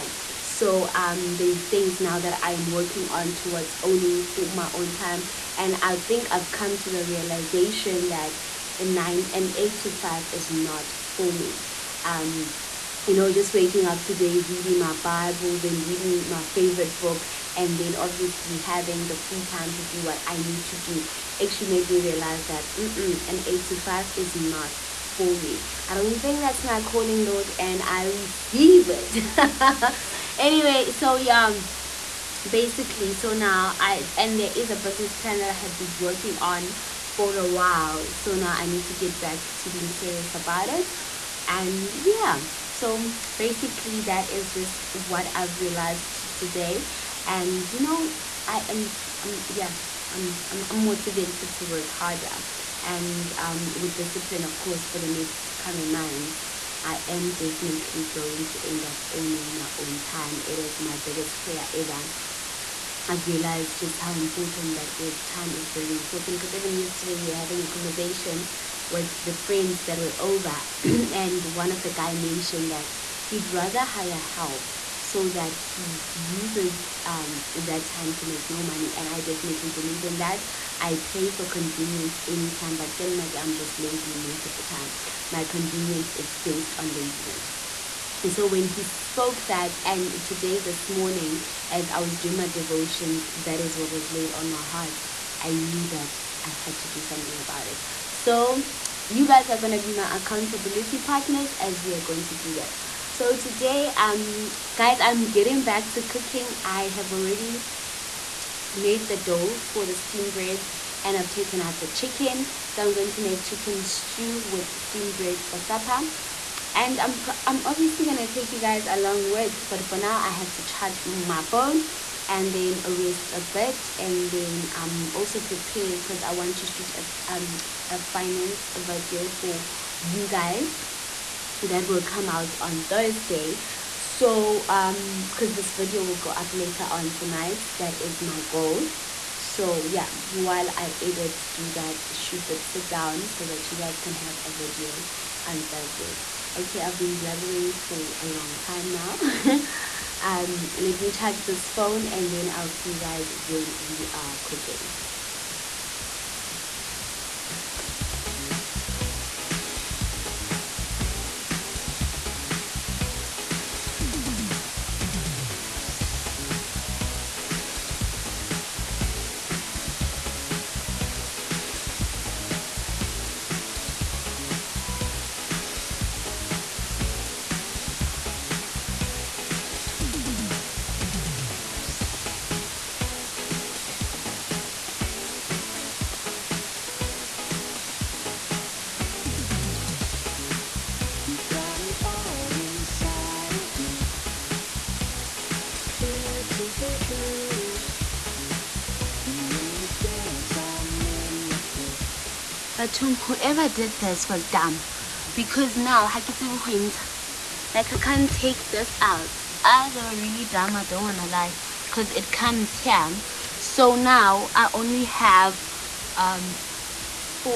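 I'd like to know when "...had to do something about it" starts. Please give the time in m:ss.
1:36.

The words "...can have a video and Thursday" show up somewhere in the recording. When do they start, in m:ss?
2:24.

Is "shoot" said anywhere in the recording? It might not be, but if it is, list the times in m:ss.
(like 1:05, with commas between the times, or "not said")
2:06, 2:22.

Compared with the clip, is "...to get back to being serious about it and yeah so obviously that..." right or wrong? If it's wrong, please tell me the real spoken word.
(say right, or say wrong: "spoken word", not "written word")
wrong: "basically", not "obviously".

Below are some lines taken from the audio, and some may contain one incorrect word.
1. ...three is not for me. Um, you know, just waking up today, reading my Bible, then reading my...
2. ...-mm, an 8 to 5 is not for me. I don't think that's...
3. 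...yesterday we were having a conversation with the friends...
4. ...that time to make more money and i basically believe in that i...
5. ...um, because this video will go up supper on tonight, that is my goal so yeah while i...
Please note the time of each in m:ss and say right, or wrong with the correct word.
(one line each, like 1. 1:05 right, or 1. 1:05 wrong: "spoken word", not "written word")
1. 0:09 wrong: "five", not "three"
2. 0:22 right
3. 1:06 right
4. 1:17 wrong: "definitely", not "basically"
5. 2:14 wrong: "later", not "supper".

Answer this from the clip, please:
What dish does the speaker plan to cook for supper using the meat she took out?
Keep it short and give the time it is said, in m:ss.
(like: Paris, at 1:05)
chicken stew, at 1:53.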